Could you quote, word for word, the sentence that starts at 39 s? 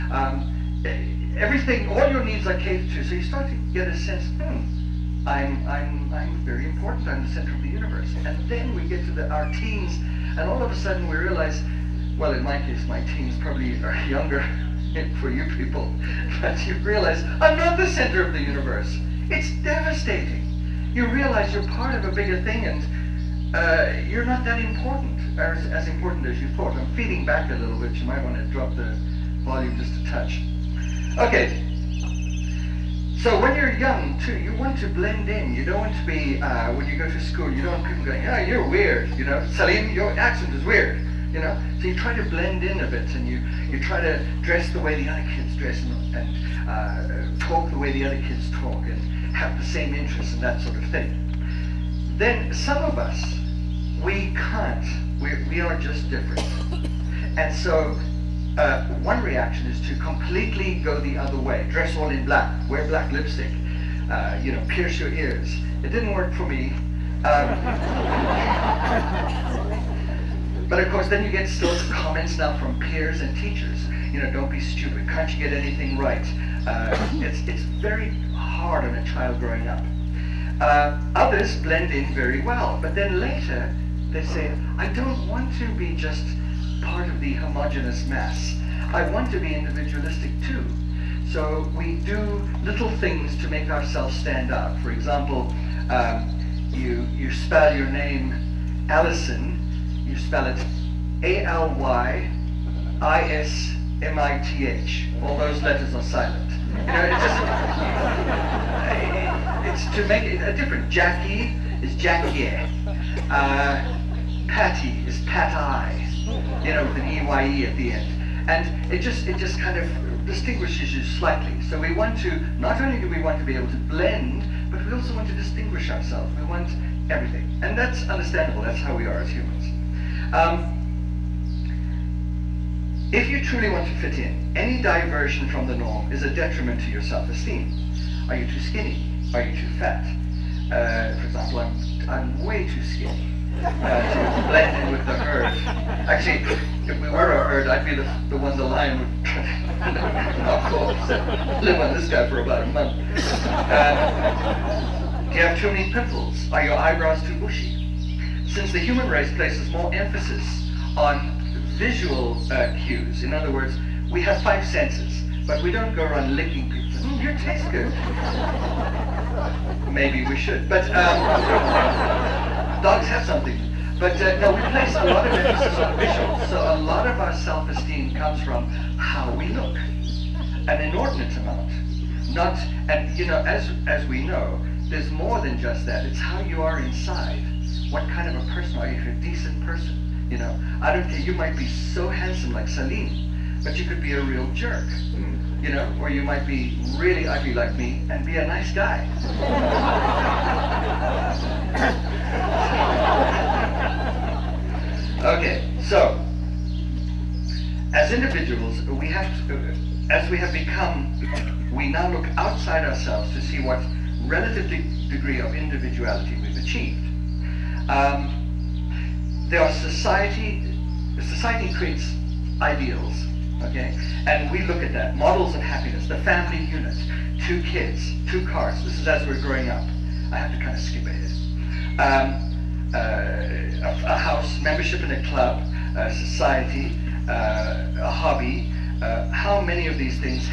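Salim, your accent is weird you know?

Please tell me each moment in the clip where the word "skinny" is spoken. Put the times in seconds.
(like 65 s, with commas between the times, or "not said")
138 s, 142 s.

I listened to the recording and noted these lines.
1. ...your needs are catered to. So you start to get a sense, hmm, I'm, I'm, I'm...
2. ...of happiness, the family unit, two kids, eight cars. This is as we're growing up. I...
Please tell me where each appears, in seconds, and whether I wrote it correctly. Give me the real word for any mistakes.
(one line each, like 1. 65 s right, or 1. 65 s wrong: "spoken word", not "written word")
1. 2 s right
2. 225 s wrong: "two", not "eight".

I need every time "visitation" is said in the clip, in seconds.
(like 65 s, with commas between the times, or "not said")
not said.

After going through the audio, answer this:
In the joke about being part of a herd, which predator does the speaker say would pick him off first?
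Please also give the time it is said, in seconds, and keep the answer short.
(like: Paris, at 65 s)
The lion, at 148 s.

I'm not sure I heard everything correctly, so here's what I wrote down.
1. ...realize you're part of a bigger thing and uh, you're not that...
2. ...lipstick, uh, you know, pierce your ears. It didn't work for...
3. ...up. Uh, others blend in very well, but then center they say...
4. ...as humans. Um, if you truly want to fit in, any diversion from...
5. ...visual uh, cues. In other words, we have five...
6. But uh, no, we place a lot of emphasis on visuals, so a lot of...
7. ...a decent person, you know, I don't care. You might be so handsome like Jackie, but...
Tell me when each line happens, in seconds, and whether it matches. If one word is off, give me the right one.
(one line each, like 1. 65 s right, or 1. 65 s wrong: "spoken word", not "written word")
1. 21 s right
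2. 63 s right
3. 79 s wrong: "later", not "center"
4. 129 s right
5. 161 s right
6. 173 s right
7. 189 s wrong: "Salim", not "Jackie".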